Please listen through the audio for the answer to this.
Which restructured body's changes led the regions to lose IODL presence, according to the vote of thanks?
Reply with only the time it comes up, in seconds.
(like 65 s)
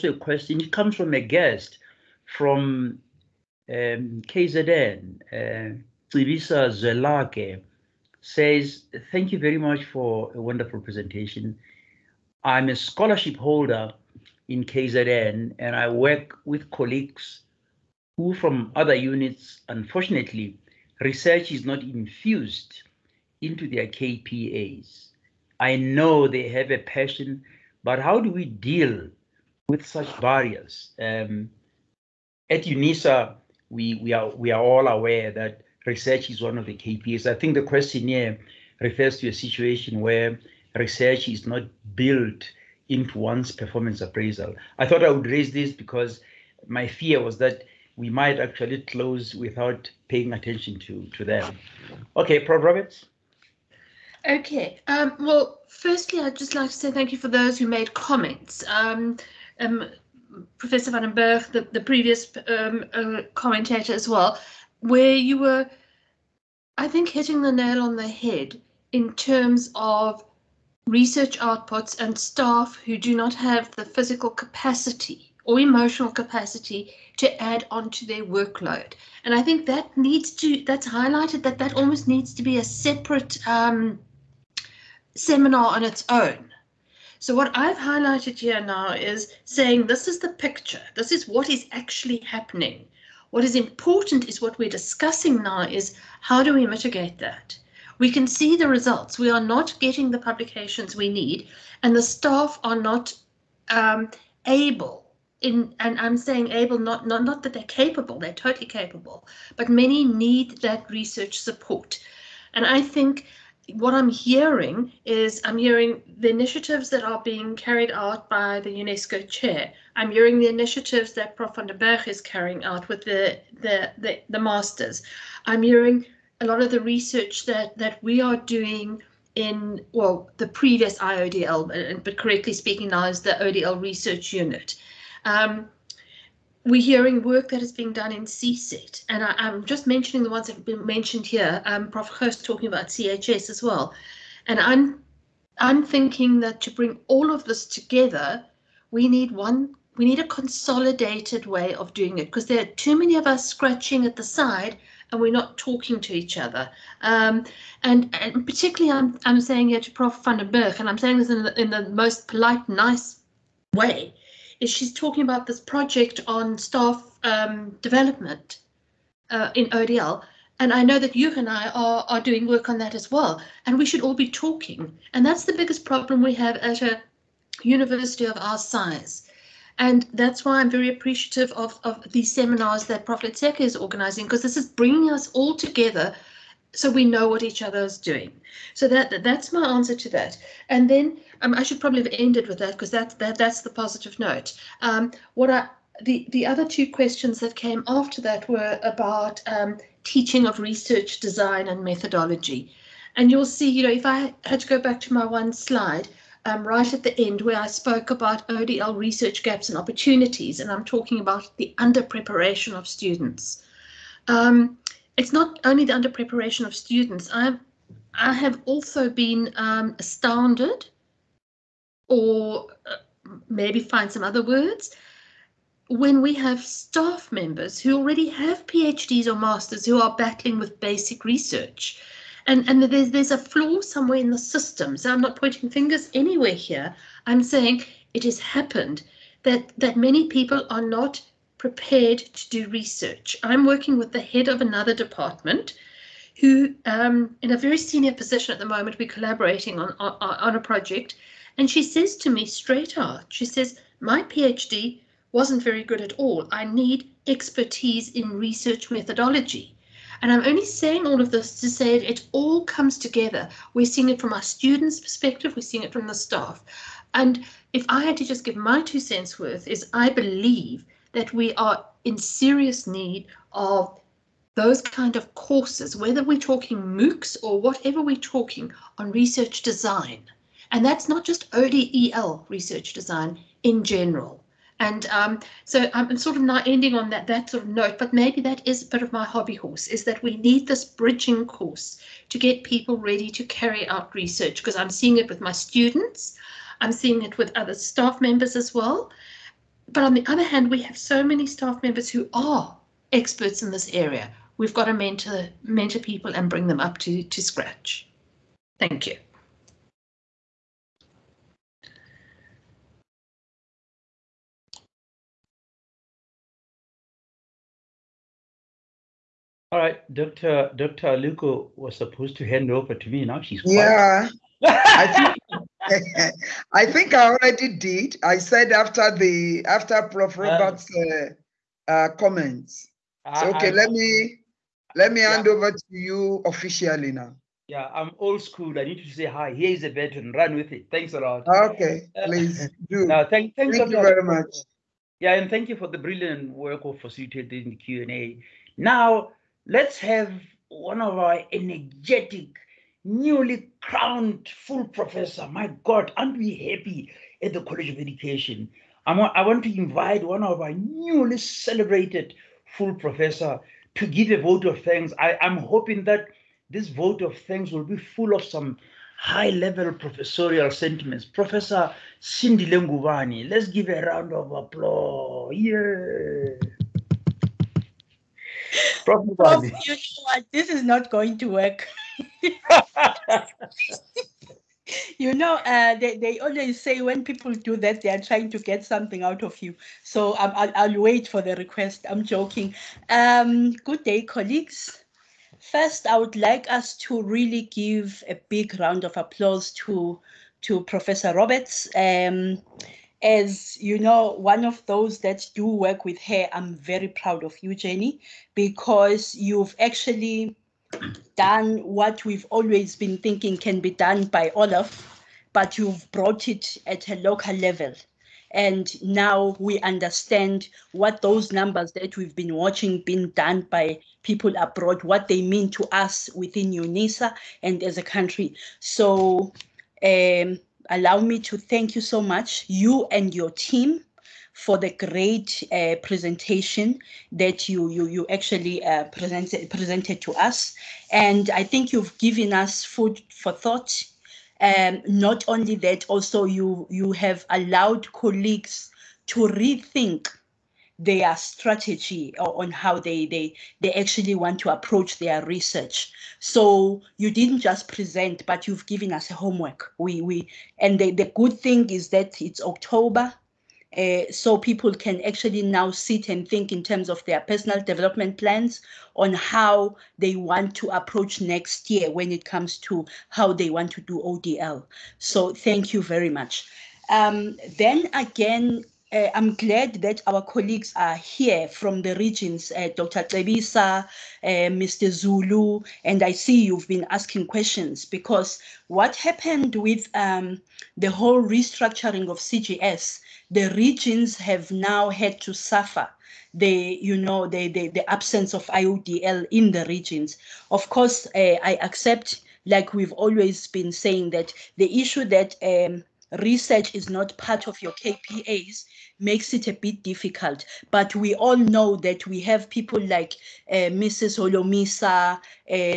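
492 s.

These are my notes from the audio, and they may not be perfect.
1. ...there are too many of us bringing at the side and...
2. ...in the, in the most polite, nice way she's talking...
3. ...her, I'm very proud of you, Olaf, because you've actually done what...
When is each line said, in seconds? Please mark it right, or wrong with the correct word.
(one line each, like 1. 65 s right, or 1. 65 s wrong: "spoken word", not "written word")
1. 152 s wrong: "scratching", not "bringing"
2. 161 s right
3. 406 s wrong: "Jenny", not "Olaf".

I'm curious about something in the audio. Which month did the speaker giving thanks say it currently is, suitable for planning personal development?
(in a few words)
October.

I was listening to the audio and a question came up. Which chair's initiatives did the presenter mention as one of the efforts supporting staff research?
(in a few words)
UNESCO chair.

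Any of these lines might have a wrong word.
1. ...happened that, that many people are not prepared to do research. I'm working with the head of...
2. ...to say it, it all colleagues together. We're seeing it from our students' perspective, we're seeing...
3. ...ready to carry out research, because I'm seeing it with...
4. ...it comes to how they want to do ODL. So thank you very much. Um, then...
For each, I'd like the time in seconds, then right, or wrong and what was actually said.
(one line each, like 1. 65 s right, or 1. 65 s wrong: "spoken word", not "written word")
1. 238 s right
2. 261 s wrong: "comes", not "colleagues"
3. 292 s right
4. 472 s right.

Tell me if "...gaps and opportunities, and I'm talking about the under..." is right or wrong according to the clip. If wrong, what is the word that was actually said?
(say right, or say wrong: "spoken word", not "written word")
right.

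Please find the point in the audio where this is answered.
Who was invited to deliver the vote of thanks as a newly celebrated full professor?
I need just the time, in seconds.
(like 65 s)
372 s.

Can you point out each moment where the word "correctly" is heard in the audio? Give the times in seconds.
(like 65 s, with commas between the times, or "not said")
132 s.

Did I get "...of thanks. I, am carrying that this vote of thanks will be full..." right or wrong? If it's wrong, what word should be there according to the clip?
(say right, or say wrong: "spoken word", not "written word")
wrong: "hoping", not "carrying".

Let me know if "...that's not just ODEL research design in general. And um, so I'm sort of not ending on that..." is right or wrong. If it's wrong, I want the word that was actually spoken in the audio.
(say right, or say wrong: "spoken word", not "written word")
right.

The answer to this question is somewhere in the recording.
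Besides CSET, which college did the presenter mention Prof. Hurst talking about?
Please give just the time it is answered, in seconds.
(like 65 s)
142 s.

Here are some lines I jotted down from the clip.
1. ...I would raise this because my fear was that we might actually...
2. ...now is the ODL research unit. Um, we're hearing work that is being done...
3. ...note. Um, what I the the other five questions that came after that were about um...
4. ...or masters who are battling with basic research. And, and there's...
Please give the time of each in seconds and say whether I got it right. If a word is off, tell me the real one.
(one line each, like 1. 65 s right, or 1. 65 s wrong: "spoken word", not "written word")
1. 45 s right
2. 132 s right
3. 194 s wrong: "two", not "five"
4. 229 s right.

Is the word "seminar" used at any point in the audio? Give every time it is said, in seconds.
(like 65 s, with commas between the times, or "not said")
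85 s, 182 s.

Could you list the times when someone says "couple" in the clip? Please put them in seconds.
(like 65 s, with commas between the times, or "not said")
not said.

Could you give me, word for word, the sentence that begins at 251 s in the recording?
And she says to me straight out, she says, my PhD wasn't very good at all.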